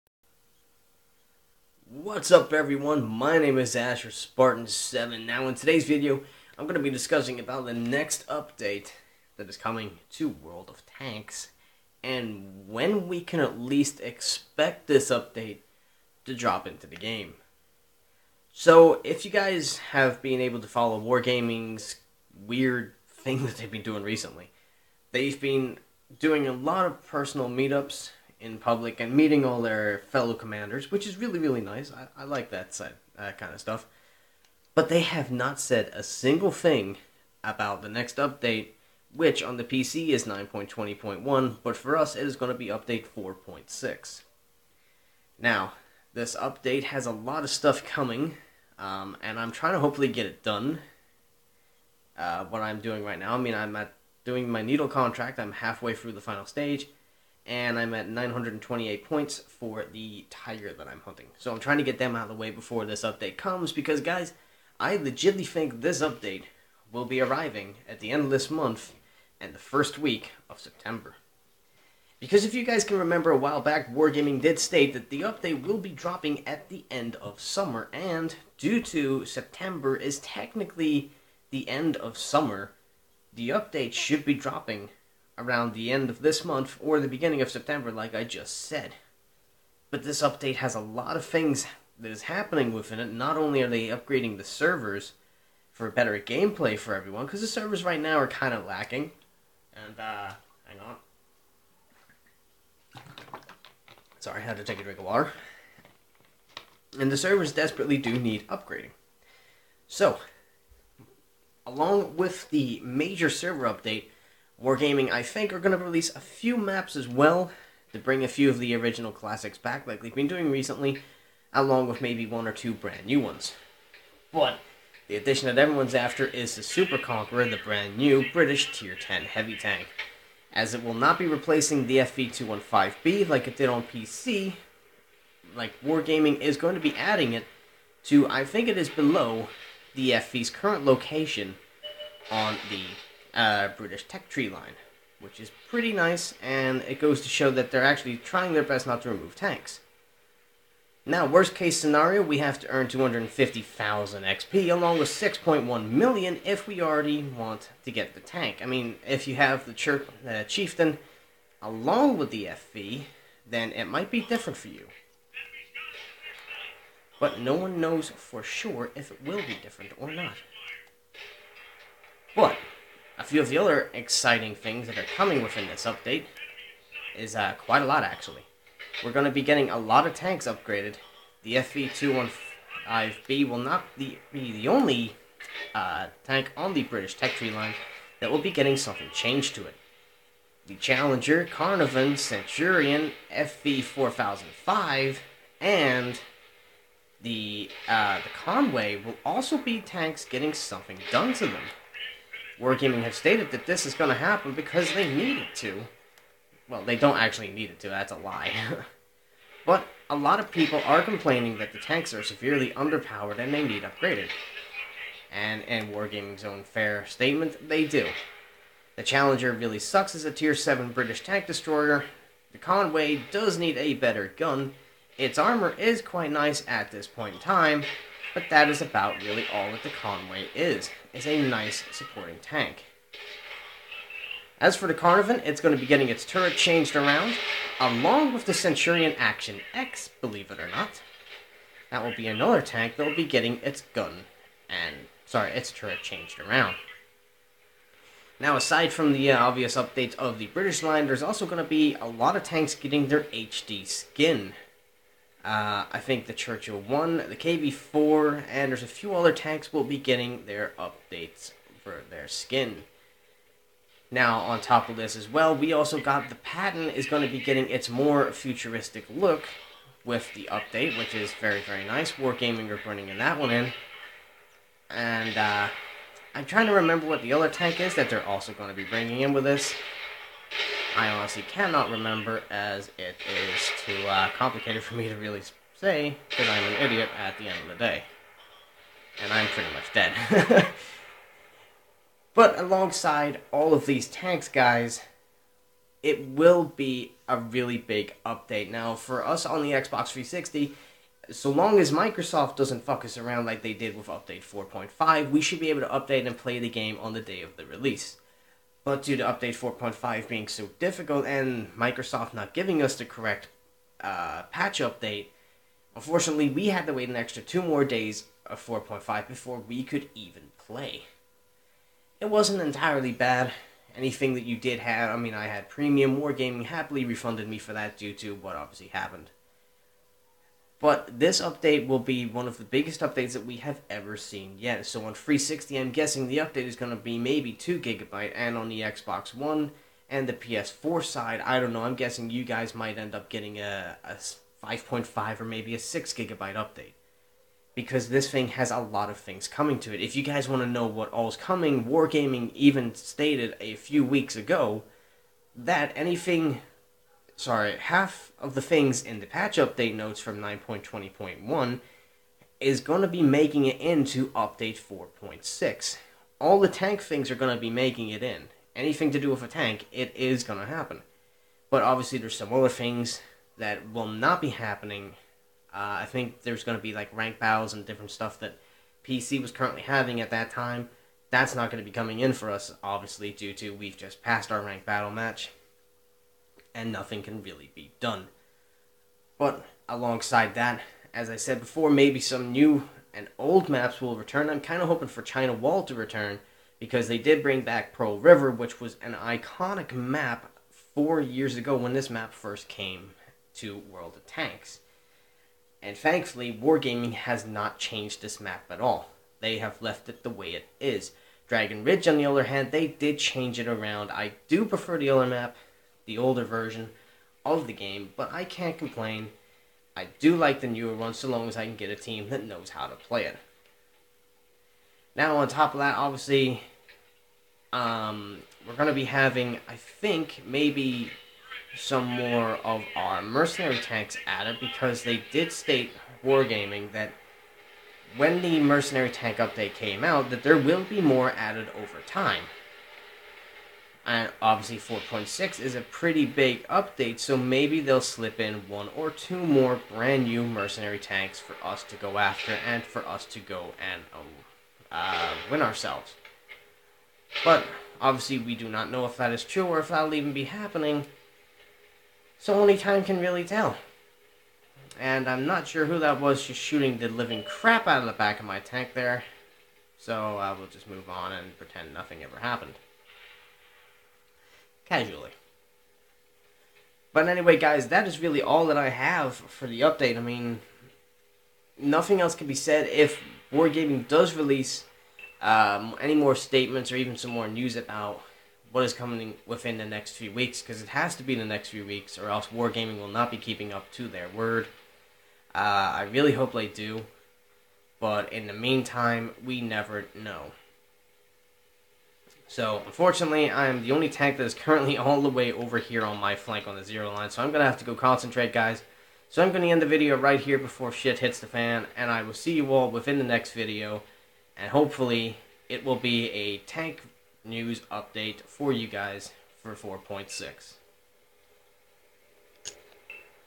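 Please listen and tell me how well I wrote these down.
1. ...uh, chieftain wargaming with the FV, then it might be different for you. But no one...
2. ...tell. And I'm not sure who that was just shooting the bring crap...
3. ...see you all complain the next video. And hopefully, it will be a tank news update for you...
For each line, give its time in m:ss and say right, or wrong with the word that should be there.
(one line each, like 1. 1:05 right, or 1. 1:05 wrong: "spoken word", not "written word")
1. 2:40 wrong: "along", not "wargaming"
2. 7:43 wrong: "living", not "bring"
3. 8:32 wrong: "within", not "complain".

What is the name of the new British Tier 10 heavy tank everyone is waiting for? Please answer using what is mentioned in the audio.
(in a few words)
Super Conqueror.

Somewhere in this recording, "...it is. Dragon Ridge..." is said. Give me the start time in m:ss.
6:50.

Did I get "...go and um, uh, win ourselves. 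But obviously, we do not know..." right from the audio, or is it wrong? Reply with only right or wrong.
right.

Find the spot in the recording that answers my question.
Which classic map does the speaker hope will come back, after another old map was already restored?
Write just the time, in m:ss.
6:35.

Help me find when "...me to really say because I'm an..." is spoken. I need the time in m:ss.
4:44.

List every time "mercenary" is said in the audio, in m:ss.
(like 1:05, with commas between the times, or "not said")
7:13, 7:18, 7:30.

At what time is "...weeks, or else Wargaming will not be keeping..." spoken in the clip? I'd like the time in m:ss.
8:11.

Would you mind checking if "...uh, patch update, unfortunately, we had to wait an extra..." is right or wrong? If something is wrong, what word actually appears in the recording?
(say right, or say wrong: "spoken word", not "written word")
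right.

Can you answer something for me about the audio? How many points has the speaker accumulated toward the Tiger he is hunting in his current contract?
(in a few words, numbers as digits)
928.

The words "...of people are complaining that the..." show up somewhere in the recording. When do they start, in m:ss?
3:30.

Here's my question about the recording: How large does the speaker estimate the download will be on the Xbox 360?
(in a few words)
2 gigabytes.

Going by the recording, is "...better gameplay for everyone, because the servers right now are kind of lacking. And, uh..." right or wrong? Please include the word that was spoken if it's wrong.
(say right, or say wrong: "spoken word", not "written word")
right.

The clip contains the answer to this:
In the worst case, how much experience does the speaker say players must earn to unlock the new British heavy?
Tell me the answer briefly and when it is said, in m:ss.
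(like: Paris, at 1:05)
250,000 XP, at 2:32.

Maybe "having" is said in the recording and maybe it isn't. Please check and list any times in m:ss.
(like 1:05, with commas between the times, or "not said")
6:19, 7:09.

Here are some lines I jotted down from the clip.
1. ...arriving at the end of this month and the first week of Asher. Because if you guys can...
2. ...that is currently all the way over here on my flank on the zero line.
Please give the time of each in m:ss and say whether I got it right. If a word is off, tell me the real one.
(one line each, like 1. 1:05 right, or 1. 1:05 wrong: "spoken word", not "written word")
1. 1:07 wrong: "September", not "Asher"
2. 8:24 right.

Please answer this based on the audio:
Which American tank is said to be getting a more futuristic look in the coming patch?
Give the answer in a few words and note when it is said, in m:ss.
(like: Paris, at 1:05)
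Patton, at 4:26.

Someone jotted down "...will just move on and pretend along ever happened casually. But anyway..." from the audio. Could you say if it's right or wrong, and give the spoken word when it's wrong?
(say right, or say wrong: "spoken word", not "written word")
wrong: "nothing", not "along".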